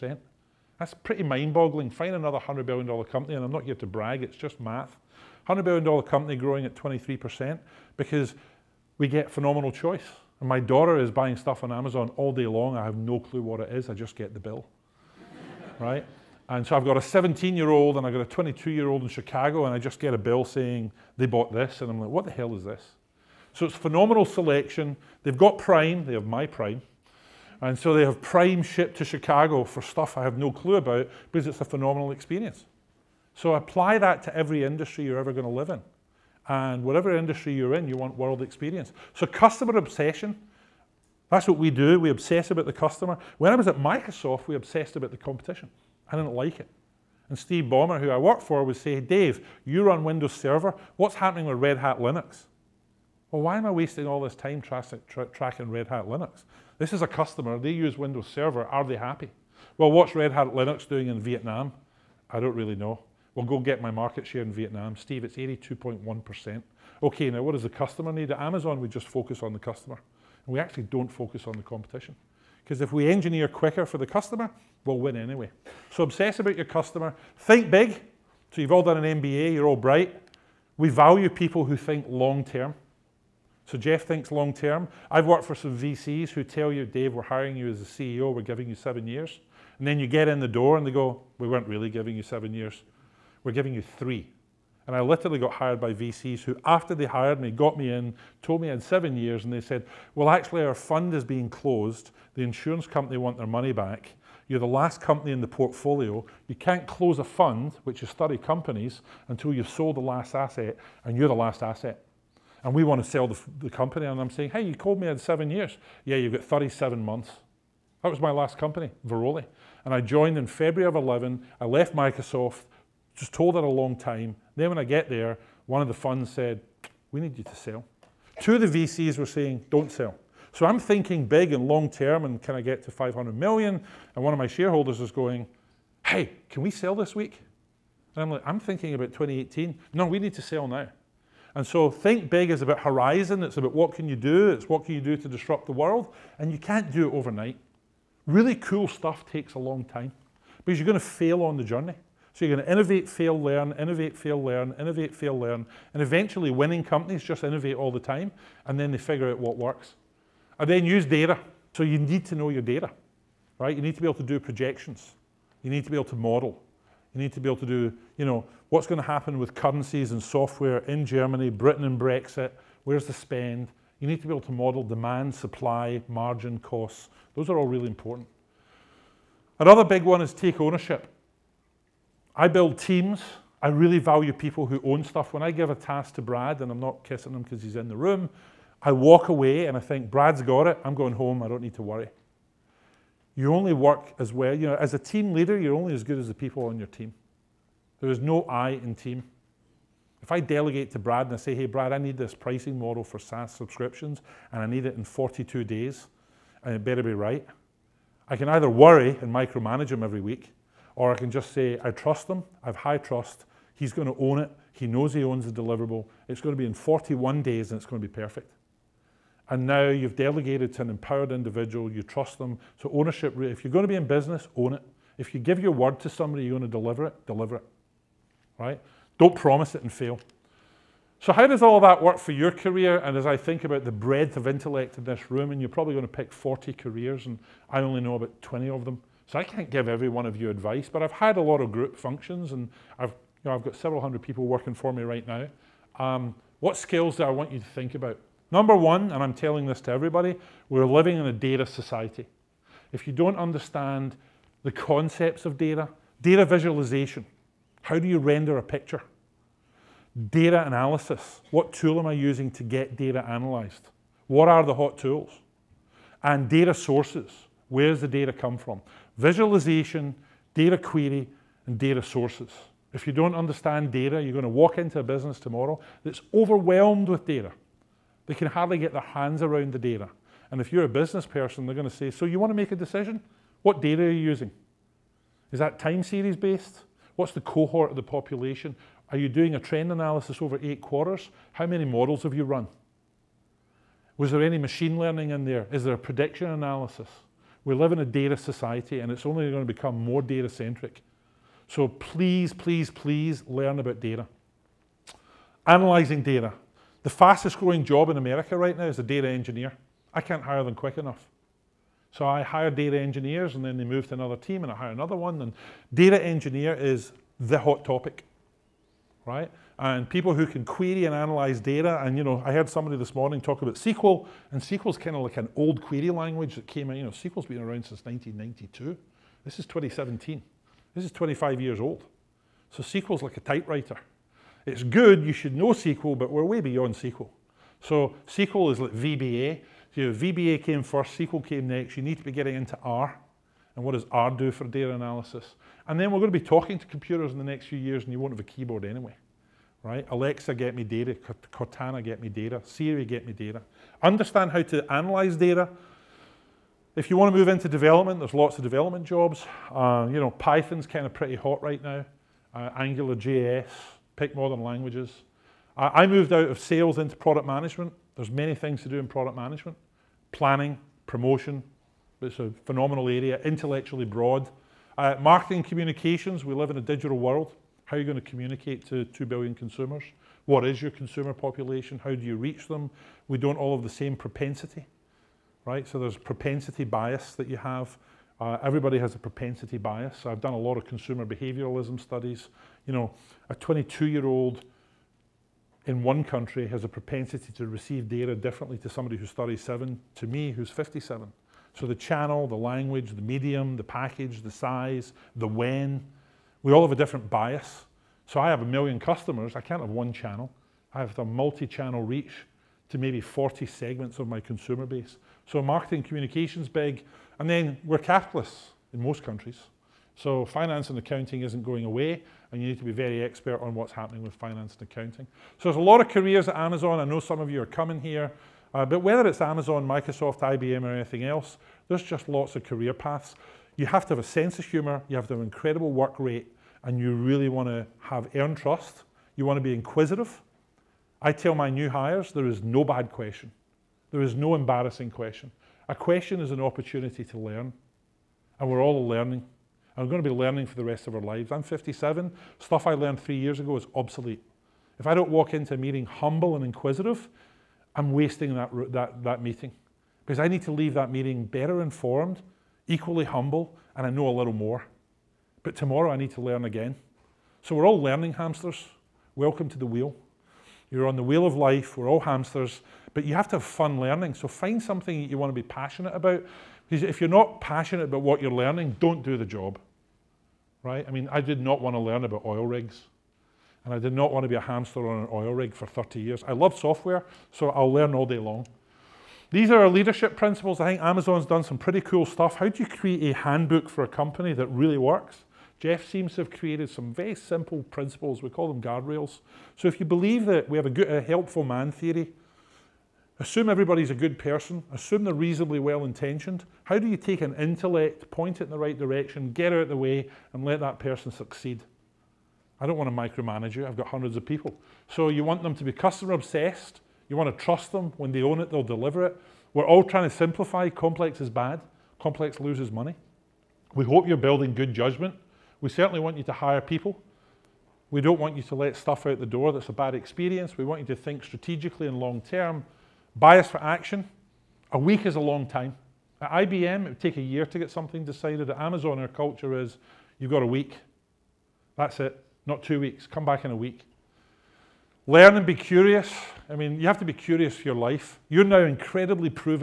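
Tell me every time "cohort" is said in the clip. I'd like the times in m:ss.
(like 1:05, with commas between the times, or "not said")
4:47.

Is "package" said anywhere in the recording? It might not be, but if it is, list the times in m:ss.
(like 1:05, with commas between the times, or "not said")
6:43.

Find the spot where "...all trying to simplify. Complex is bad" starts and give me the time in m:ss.
8:39.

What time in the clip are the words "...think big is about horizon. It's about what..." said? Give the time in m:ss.
2:21.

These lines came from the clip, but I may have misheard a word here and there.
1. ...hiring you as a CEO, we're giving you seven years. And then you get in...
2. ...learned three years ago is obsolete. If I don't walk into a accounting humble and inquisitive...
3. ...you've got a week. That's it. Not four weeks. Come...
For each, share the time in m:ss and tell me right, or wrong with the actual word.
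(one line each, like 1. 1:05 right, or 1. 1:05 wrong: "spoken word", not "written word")
1. 1:27 right
2. 7:32 wrong: "meeting", not "accounting"
3. 9:00 wrong: "two", not "four".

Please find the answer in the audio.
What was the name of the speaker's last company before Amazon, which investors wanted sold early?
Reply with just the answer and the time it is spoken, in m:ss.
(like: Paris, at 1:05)
Veroli, at 1:59.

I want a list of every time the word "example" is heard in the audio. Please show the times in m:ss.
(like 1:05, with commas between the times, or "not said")
not said.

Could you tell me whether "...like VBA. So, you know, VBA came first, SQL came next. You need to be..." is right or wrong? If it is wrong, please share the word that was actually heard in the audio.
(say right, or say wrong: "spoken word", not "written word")
right.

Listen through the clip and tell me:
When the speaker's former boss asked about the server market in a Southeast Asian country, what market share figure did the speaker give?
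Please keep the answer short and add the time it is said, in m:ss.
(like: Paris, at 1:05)
82.1%, at 1:05.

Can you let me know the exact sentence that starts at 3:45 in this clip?
If you give your word to somebody, you're going to deliver it, deliver it.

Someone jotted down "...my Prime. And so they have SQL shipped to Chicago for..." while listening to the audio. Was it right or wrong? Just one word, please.
wrong.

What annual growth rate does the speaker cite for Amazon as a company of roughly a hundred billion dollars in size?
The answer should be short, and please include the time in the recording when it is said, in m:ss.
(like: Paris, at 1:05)
23%, at 0:06.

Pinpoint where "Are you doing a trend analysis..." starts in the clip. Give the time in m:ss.
4:49.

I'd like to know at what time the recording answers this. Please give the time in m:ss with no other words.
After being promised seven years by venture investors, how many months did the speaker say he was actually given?
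1:56.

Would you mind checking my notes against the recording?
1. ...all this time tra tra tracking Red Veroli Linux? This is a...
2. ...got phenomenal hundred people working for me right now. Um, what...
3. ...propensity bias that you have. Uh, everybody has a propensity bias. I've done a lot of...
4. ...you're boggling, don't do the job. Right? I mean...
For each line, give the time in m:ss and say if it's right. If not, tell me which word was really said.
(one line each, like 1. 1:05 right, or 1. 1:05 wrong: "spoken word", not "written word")
1. 0:54 wrong: "Hat", not "Veroli"
2. 4:03 wrong: "several", not "phenomenal"
3. 6:26 right
4. 7:58 wrong: "learning", not "boggling".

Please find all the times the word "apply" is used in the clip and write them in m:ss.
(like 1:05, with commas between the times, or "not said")
0:33.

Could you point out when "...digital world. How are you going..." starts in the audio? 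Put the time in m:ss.
6:16.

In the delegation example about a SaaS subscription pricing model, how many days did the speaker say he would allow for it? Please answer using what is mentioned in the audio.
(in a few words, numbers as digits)
42 days.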